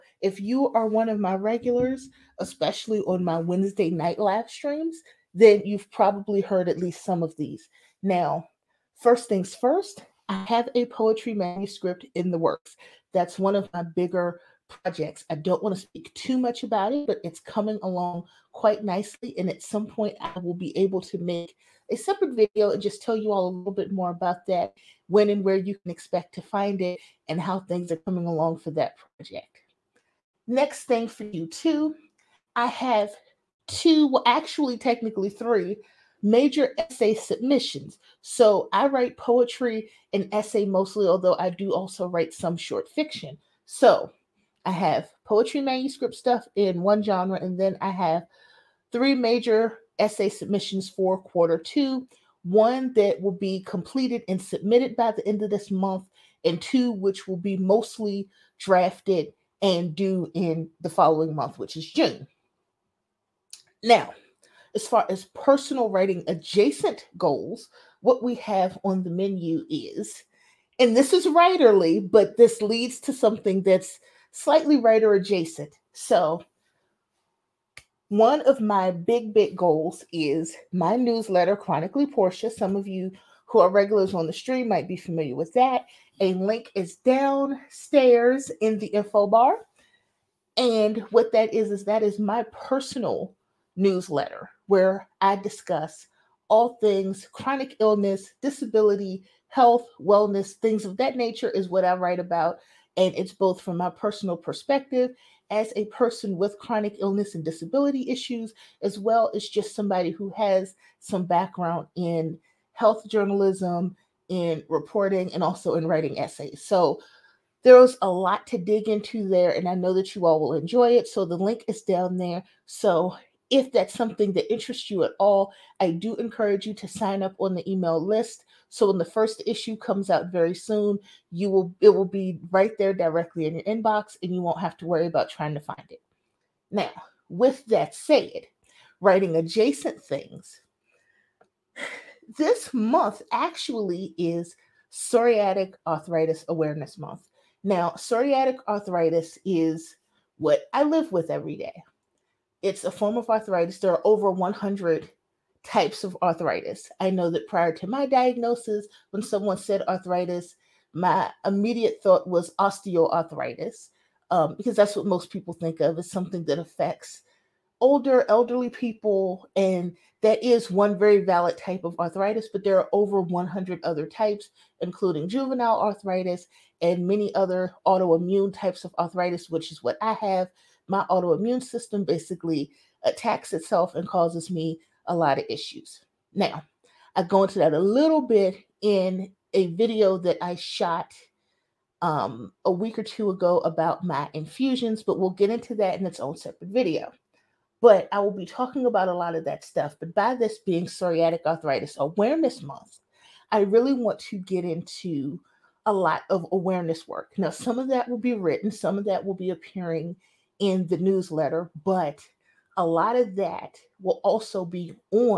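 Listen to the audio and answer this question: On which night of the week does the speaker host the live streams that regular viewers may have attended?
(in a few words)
Wednesday.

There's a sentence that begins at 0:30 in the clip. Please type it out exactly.
Next thing for Q2, I have two, well, actually, technically three major essay submissions.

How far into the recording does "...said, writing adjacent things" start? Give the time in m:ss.
2:17.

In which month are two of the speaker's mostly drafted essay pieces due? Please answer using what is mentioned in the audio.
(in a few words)
June.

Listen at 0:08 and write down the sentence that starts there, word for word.
Now, first things first, I have a poetry manuscript in the works.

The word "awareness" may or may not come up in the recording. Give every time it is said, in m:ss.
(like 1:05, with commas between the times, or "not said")
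2:26, 3:21, 3:26.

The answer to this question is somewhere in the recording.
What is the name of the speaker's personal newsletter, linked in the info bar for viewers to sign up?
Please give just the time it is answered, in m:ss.
1:21.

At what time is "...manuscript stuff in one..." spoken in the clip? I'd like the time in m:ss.
0:45.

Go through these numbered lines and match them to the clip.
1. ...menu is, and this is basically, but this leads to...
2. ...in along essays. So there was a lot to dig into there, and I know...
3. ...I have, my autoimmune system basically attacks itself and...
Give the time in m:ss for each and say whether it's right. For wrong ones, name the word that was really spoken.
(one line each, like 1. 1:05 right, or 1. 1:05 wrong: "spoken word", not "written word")
1. 1:09 wrong: "writerly", not "basically"
2. 1:55 wrong: "writing", not "along"
3. 3:00 right.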